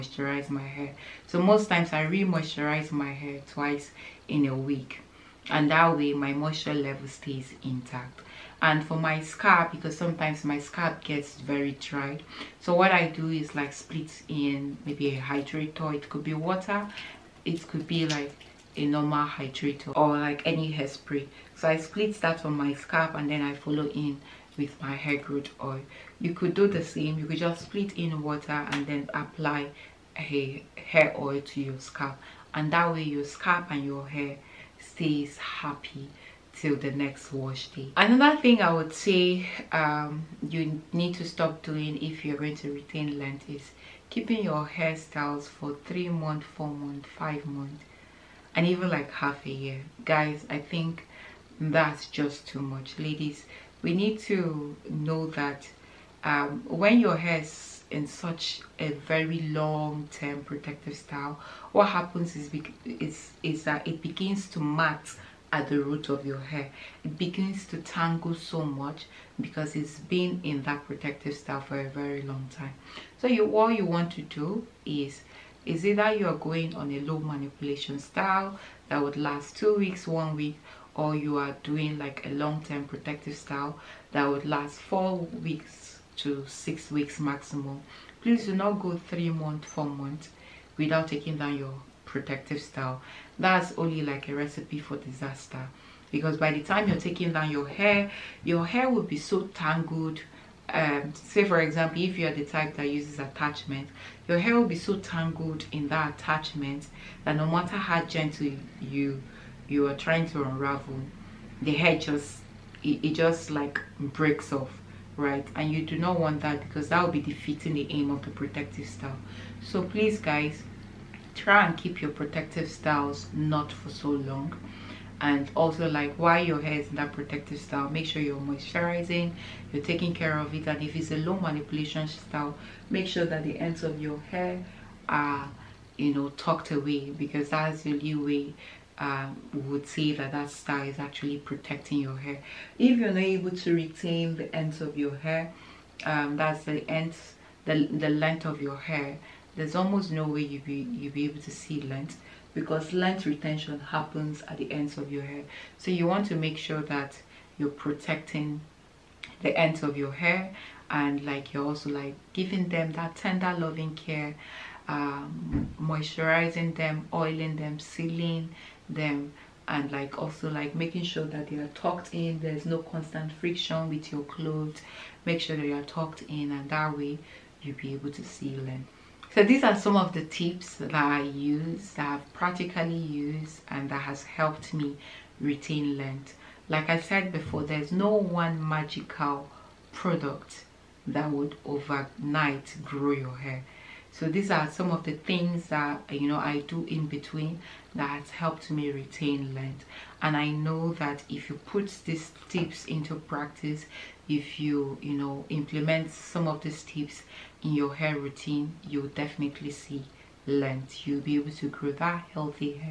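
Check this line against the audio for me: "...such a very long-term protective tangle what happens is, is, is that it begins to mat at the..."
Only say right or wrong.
wrong.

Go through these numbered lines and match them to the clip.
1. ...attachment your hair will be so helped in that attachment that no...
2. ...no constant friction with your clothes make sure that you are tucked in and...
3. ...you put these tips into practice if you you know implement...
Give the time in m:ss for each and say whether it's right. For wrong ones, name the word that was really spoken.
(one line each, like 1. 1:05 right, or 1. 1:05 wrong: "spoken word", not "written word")
1. 1:43 wrong: "tangled", not "helped"
2. 2:52 right
3. 3:21 right.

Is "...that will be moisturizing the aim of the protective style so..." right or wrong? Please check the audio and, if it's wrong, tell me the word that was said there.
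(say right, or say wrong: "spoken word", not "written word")
wrong: "defeating", not "moisturizing".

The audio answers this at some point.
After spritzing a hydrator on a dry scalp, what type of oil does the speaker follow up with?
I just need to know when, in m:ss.
0:24.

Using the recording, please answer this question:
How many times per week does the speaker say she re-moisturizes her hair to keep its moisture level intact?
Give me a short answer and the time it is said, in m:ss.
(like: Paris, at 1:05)
twice, at 0:03.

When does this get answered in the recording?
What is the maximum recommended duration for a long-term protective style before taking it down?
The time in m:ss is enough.
1:26.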